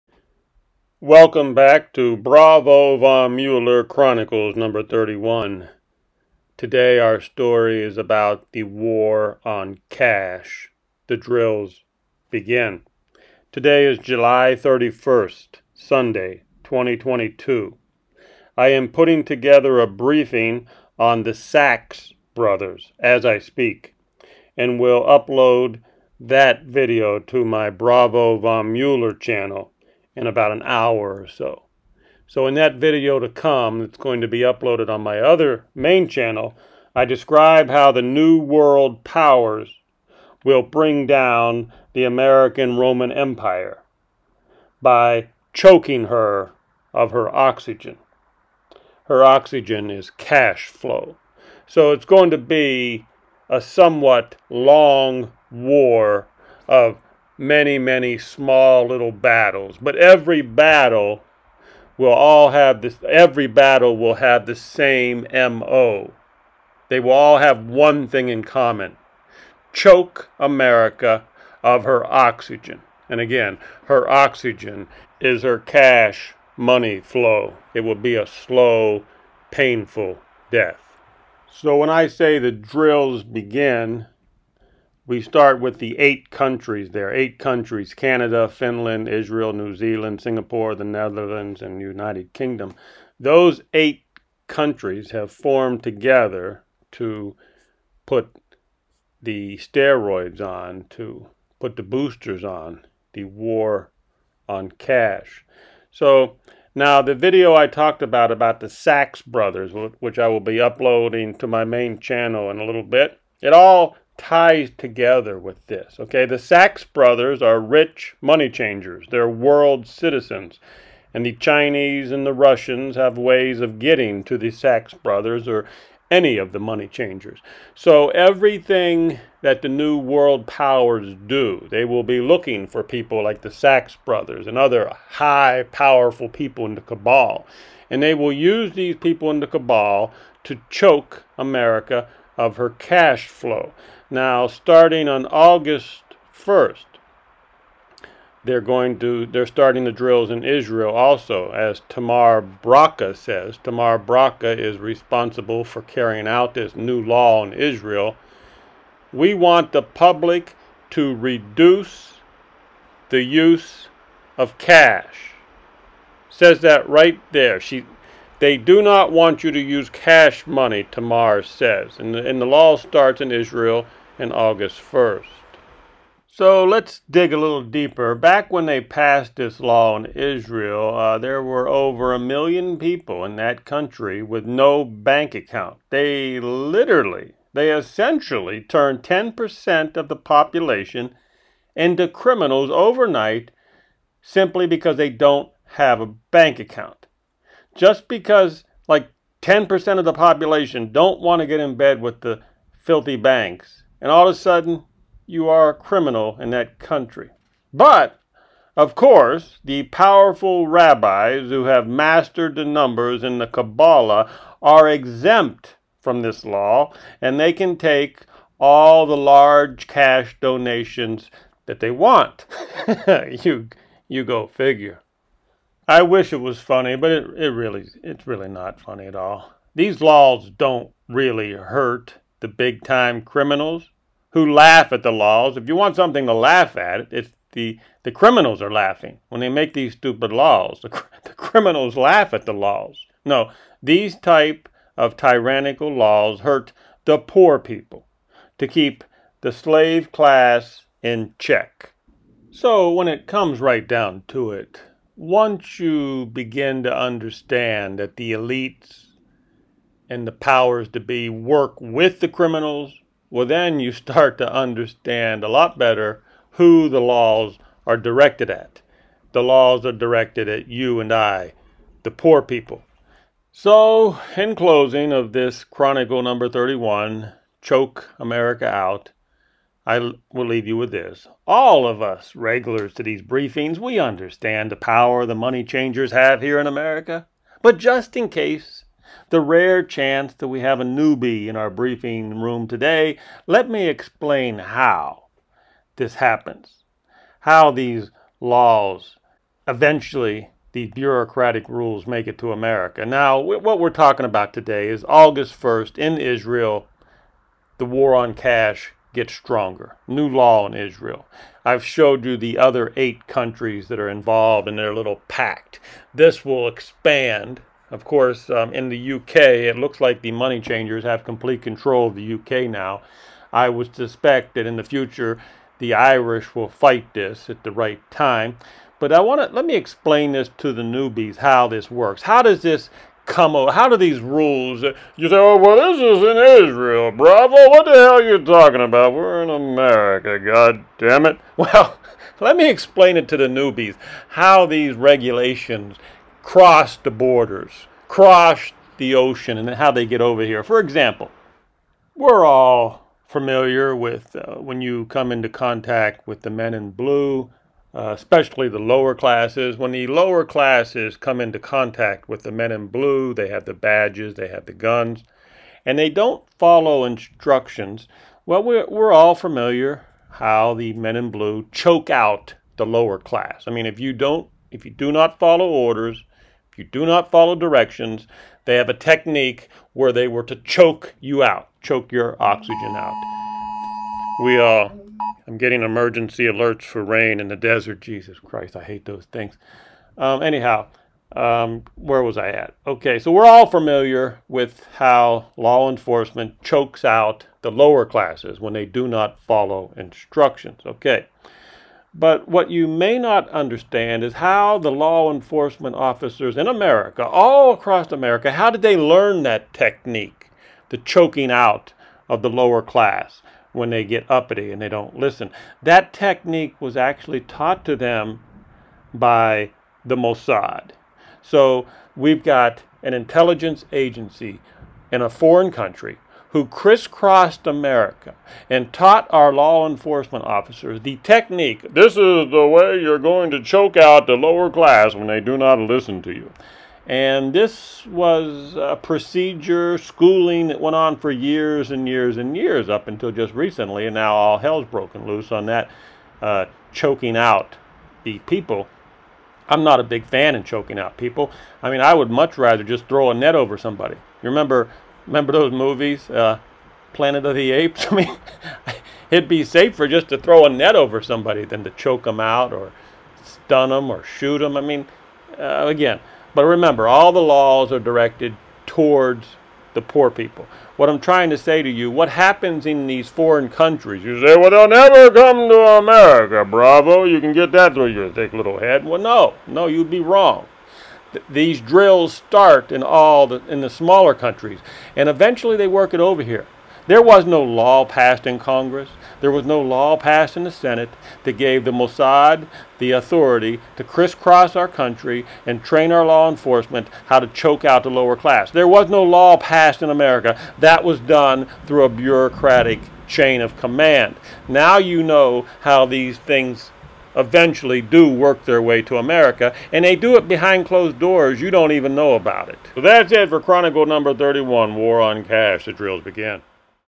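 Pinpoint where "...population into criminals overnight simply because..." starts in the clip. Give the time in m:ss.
3:10.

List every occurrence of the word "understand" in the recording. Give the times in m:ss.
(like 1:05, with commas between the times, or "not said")
4:16, 4:24, 4:43, 6:43.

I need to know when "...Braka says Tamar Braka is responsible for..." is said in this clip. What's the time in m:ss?
2:32.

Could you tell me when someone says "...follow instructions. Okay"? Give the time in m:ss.
6:39.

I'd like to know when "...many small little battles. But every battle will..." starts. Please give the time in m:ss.
0:57.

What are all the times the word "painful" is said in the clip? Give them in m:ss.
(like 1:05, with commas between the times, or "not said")
1:19.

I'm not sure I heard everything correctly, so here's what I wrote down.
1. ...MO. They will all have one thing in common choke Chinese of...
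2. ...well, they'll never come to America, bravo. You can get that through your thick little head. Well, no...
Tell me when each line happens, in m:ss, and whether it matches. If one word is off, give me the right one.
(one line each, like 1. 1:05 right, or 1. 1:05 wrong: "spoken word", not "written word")
1. 1:05 wrong: "America", not "Chinese"
2. 7:54 right.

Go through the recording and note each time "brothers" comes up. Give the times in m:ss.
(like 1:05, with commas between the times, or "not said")
0:22, 1:49, 1:56, 2:04, 2:14.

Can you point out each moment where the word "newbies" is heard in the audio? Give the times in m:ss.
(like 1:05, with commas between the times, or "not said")
4:50, 5:30, 5:43.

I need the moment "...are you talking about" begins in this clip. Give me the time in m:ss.
5:38.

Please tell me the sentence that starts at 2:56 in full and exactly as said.
So let's dig a little deeper.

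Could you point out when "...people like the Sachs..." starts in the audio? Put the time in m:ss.
2:12.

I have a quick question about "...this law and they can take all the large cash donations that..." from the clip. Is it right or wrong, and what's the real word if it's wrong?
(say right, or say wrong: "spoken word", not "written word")
right.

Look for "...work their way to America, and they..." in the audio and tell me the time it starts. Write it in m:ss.
8:28.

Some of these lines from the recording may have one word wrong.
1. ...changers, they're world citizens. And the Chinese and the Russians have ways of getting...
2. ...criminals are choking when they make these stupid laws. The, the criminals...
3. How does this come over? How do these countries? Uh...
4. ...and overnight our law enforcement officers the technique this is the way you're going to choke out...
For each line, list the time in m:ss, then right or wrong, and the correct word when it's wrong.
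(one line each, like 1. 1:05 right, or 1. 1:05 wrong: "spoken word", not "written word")
1. 1:58 right
2. 3:58 wrong: "laughing", not "choking"
3. 5:32 wrong: "rules", not "countries"
4. 7:08 wrong: "taught", not "overnight".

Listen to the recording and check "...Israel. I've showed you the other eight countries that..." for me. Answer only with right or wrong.
right.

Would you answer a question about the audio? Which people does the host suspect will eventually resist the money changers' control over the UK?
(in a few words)
the Irish.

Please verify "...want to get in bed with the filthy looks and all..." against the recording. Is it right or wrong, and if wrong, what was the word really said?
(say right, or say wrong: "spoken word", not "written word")
wrong: "banks", not "looks".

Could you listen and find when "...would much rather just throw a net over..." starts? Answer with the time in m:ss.
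7:32.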